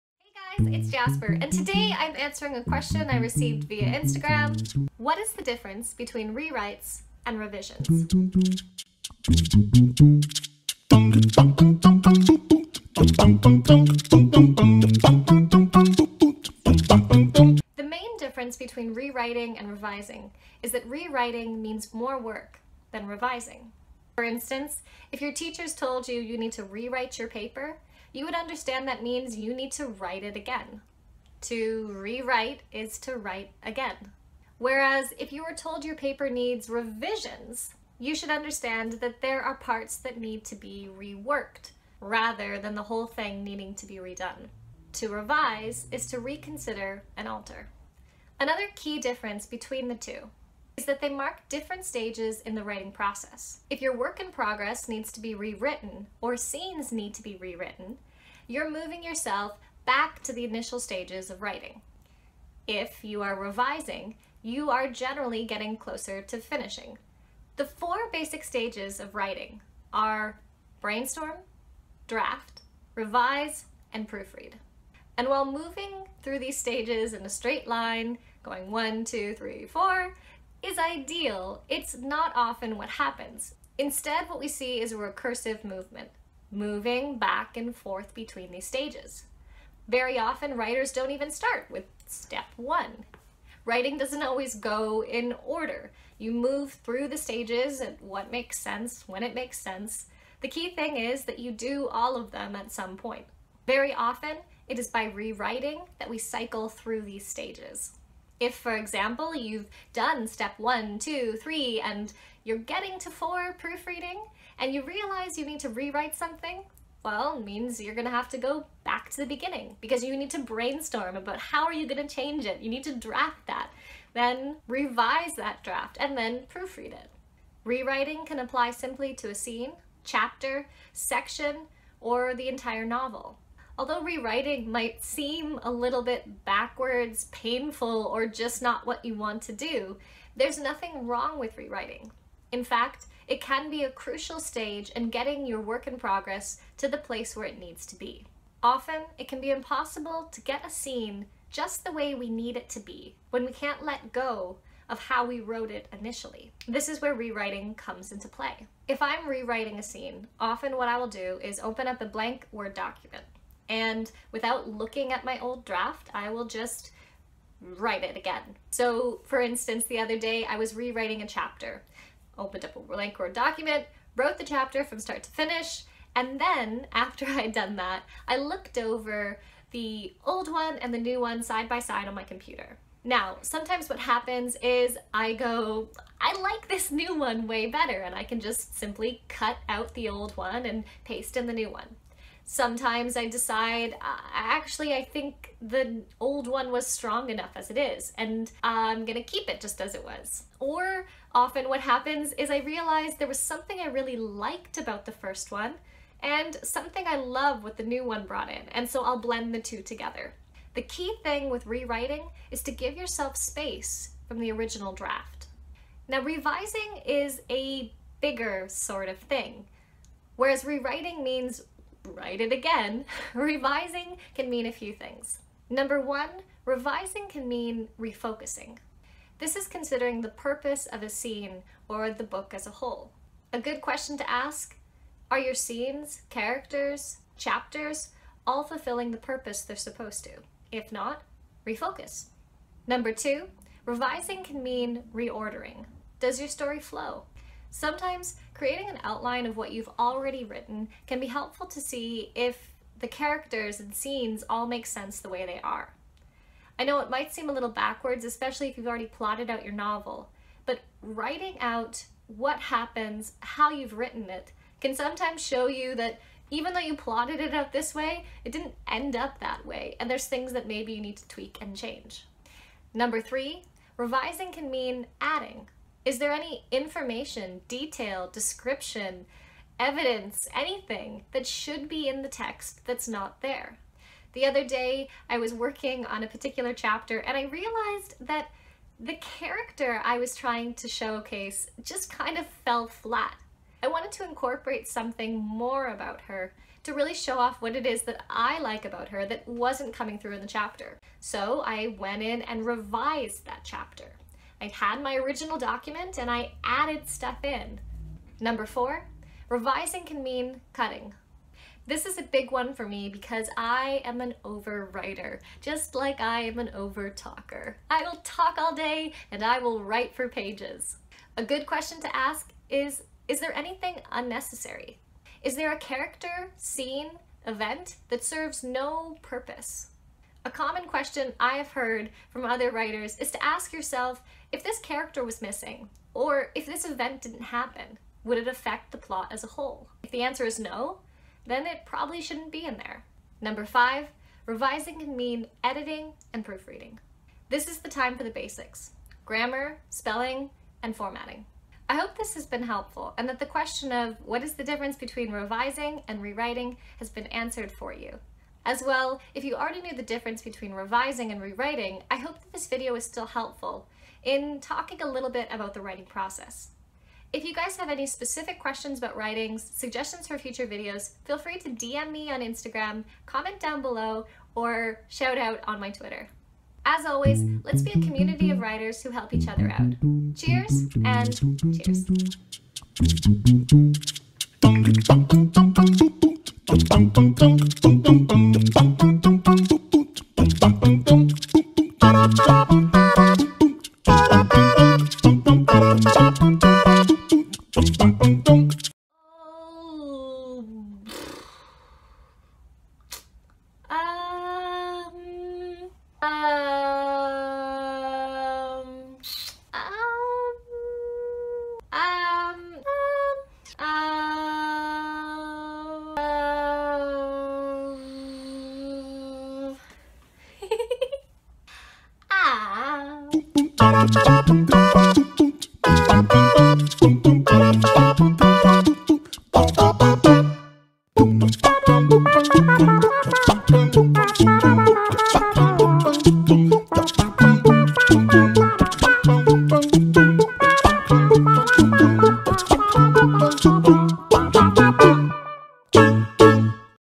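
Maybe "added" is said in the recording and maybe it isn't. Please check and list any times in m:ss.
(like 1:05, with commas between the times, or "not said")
5:06.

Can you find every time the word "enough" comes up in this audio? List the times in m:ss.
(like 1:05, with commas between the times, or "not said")
3:17.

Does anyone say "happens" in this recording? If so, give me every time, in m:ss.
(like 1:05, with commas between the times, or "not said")
1:22, 3:03, 3:21, 4:22, 5:37.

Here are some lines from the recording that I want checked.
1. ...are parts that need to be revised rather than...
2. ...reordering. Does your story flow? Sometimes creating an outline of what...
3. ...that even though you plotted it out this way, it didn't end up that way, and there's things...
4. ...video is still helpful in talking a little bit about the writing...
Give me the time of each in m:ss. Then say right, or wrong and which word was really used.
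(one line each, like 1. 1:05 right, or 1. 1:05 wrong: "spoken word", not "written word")
1. 0:39 wrong: "reworked", not "revised"
2. 4:05 right
3. 4:25 right
4. 6:02 right.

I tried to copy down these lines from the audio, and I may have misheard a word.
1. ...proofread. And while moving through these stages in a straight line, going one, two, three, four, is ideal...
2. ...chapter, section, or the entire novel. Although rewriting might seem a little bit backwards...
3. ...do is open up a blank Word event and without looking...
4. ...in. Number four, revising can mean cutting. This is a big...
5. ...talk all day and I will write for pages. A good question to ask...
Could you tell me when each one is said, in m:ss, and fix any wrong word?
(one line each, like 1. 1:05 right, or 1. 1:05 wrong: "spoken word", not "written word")
1. 1:14 right
2. 2:10 right
3. 2:41 wrong: "document", not "event"
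4. 5:07 right
5. 5:18 right.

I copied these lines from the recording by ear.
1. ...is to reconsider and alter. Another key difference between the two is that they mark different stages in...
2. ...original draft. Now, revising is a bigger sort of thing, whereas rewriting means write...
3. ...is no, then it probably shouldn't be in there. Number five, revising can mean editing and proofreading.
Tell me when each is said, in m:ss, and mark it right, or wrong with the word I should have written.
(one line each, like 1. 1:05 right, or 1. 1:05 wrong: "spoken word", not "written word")
1. 0:45 right
2. 3:34 right
3. 5:40 right.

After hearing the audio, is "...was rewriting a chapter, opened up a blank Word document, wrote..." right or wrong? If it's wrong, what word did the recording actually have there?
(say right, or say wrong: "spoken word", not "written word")
right.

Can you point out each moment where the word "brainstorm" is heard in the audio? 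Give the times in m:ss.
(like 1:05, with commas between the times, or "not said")
1:10, 2:00.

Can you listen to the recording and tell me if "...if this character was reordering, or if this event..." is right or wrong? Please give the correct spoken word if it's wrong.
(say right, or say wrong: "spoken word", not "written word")
wrong: "missing", not "reordering".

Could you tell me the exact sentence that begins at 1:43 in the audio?
Very often, it is by rewriting that we cycle through these stages.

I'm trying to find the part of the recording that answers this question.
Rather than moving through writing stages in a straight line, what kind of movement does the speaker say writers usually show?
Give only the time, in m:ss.
1:24.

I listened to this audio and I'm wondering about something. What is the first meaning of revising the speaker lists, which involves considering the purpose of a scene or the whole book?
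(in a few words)
Refocusing.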